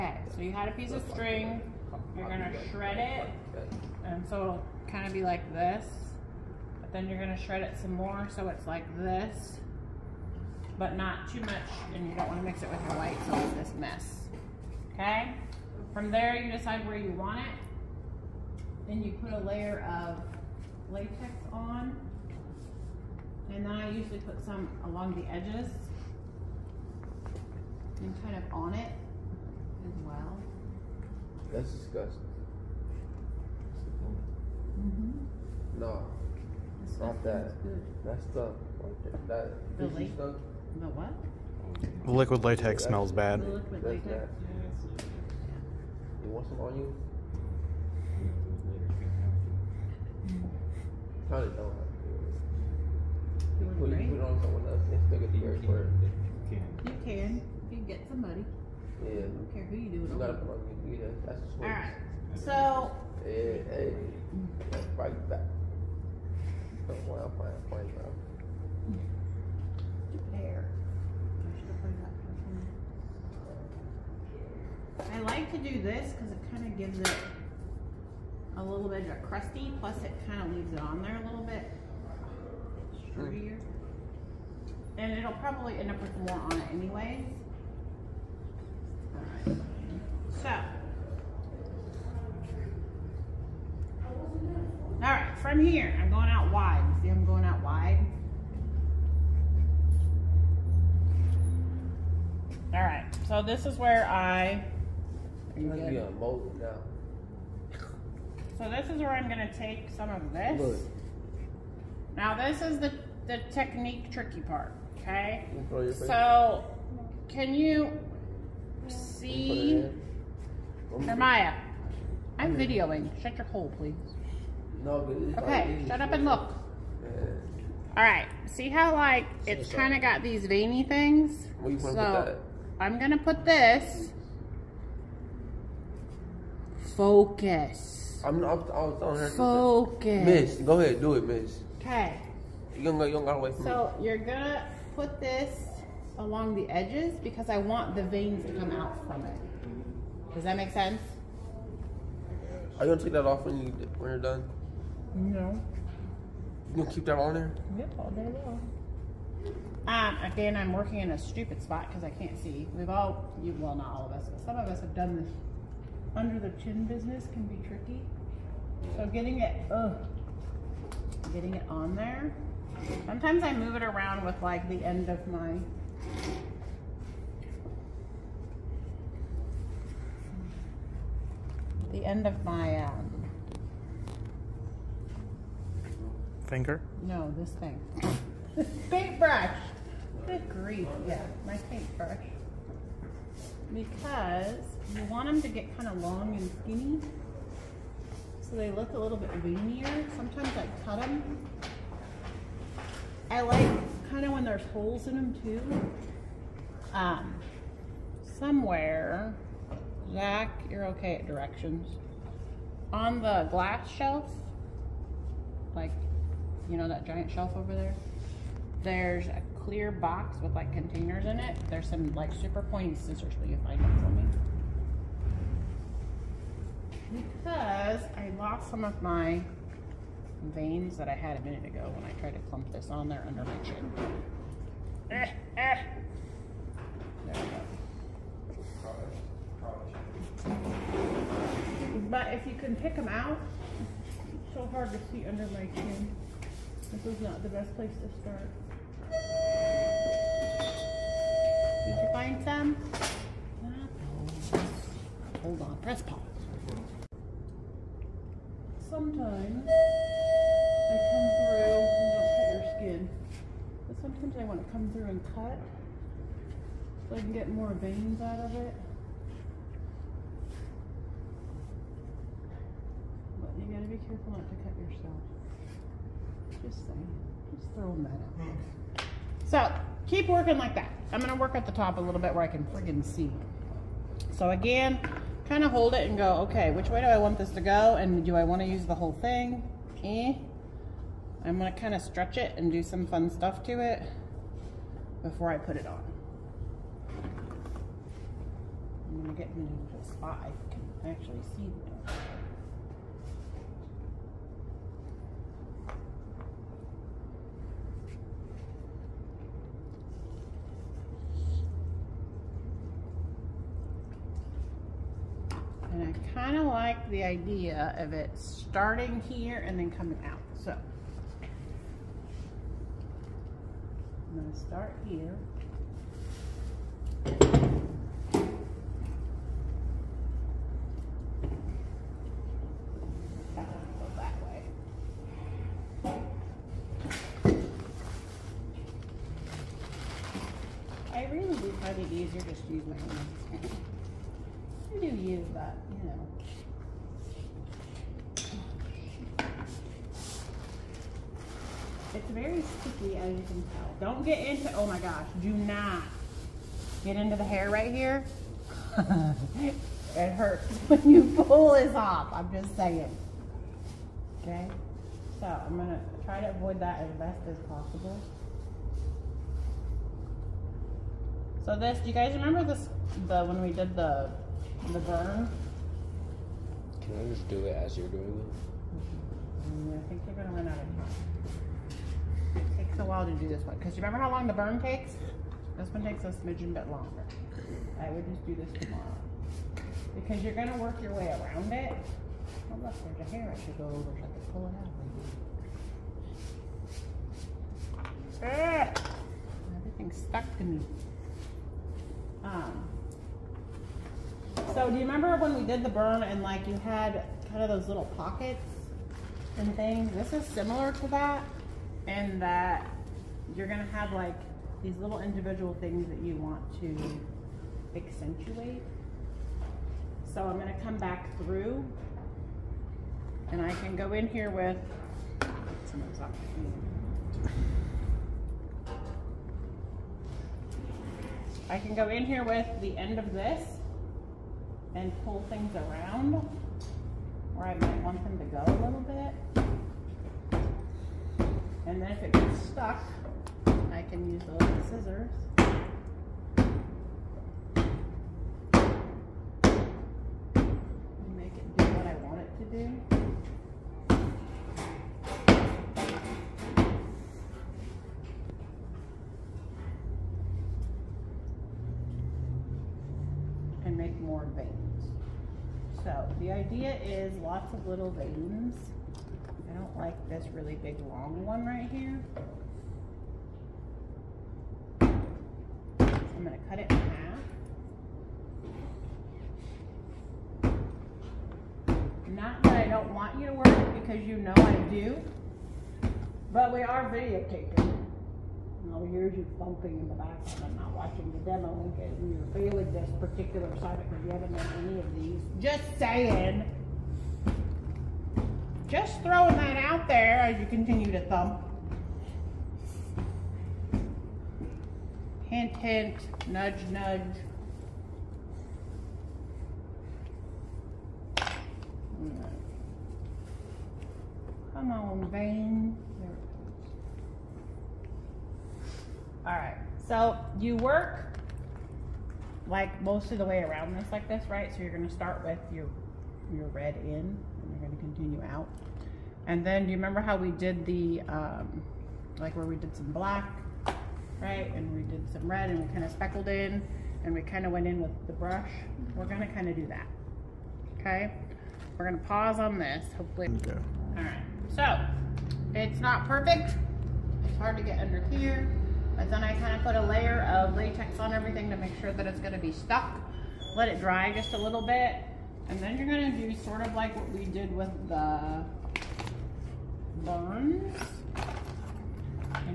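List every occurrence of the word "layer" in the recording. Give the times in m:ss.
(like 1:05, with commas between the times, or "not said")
0:19, 9:10.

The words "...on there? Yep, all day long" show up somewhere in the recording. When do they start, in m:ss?
2:37.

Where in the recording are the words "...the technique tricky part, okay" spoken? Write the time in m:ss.
1:53.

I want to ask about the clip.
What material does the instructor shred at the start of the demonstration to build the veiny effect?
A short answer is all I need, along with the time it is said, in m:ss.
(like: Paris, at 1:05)
String, at 0:01.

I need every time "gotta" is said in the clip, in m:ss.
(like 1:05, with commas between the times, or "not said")
1:00, 2:23.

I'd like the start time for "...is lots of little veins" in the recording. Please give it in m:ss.
7:47.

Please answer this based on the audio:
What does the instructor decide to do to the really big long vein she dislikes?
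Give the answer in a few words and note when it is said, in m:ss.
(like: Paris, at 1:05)
Cut it in half, at 7:56.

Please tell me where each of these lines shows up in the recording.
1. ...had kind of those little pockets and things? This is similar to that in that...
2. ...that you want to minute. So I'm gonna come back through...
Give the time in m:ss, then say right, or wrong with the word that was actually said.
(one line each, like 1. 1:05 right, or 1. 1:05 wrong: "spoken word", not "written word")
1. 6:46 right
2. 6:56 wrong: "accentuate", not "minute".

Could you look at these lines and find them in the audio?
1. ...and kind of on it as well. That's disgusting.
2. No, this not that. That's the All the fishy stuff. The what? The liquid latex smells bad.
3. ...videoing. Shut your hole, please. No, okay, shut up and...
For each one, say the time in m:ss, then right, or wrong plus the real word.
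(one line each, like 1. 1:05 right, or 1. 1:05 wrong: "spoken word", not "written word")
1. 0:28 right
2. 0:35 wrong: "That", not "All"
3. 2:02 right.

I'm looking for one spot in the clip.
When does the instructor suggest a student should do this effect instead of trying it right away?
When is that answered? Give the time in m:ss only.
6:28.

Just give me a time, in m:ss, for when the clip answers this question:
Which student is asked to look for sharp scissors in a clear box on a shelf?
3:30.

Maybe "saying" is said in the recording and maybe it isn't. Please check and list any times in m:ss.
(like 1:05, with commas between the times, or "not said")
4:36, 6:02, 8:15.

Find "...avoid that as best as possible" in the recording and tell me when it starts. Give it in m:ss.
6:06.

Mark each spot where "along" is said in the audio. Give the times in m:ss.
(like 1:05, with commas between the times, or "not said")
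0:24, 2:26.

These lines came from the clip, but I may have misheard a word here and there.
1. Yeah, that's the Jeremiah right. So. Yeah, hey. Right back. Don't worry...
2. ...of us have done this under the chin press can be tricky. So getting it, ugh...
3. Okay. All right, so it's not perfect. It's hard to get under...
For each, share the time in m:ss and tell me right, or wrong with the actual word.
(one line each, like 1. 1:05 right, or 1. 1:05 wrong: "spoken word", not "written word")
1. 1:00 wrong: "All", not "Jeremiah"
2. 2:44 wrong: "business", not "press"
3. 9:03 right.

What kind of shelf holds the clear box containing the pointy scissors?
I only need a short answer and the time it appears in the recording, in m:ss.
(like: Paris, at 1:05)
Glass shelf, at 3:33.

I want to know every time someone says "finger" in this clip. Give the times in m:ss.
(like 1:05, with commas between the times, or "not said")
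3:06.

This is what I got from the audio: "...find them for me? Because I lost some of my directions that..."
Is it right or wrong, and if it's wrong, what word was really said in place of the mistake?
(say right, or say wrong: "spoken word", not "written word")
wrong: "veins", not "directions".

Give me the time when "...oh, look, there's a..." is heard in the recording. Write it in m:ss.
6:32.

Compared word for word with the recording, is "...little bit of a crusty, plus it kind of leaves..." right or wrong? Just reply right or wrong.
right.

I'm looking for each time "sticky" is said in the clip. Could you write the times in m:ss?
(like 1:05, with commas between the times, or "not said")
5:52.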